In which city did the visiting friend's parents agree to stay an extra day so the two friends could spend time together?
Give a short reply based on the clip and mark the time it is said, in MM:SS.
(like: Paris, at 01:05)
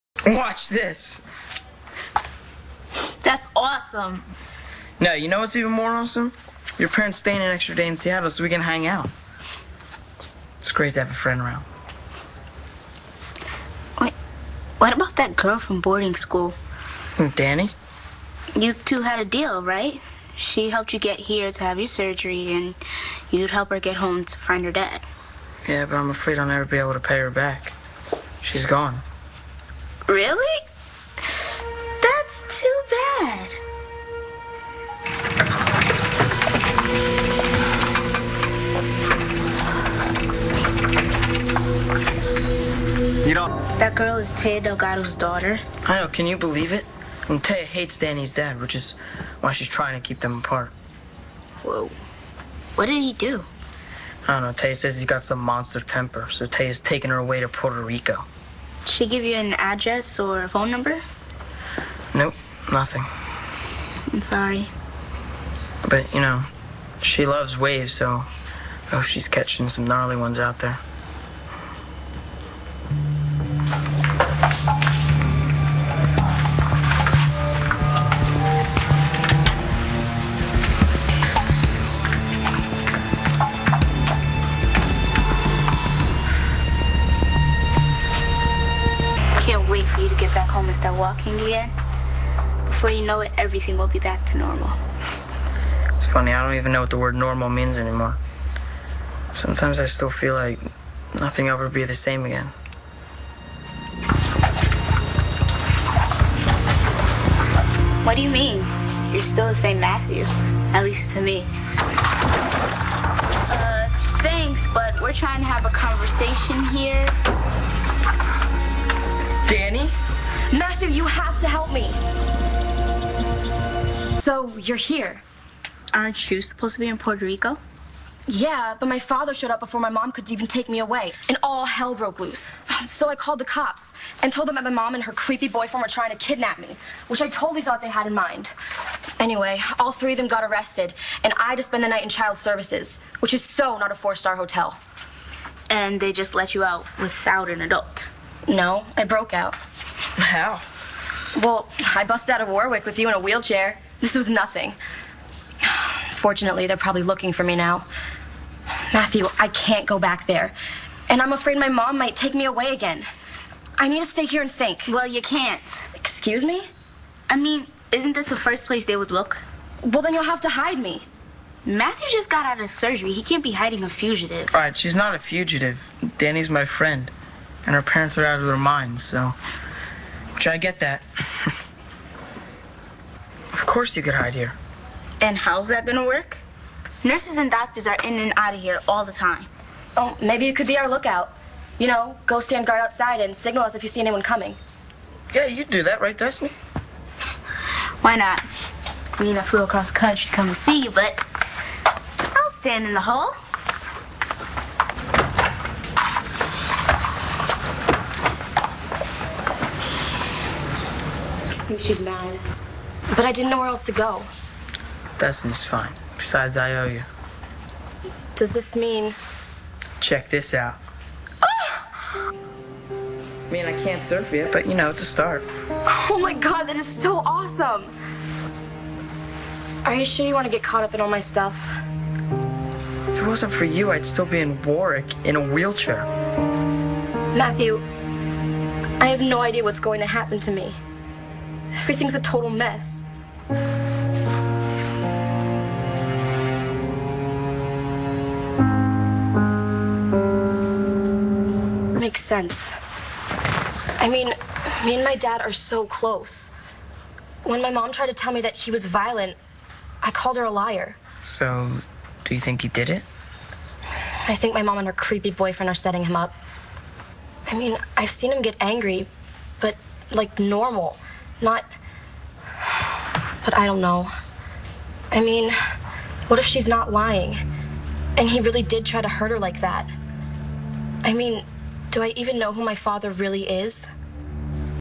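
Seattle, at 00:07.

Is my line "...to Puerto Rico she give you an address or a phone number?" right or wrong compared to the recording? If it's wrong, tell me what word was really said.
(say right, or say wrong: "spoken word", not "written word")
right.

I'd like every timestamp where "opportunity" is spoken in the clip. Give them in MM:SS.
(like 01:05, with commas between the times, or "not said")
not said.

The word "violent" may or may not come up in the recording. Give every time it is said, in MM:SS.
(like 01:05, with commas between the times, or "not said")
04:18.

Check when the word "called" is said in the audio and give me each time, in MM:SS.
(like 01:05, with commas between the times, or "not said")
02:13, 04:20.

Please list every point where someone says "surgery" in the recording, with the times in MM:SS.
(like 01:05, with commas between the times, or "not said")
00:21, 02:52.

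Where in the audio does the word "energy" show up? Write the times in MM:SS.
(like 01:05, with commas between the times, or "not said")
not said.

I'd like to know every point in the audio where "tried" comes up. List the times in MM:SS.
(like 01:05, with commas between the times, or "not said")
04:17.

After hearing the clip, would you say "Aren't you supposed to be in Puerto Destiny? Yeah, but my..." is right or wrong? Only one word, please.
wrong.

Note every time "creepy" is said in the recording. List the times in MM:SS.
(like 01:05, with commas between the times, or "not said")
02:15, 04:24.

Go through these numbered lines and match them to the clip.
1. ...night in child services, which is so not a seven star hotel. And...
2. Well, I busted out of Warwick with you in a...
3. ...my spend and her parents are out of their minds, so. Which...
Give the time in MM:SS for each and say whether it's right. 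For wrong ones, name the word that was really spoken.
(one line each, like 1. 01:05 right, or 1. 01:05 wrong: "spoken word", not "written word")
1. 02:21 wrong: "four", not "seven"
2. 02:31 right
3. 02:56 wrong: "friend", not "spend".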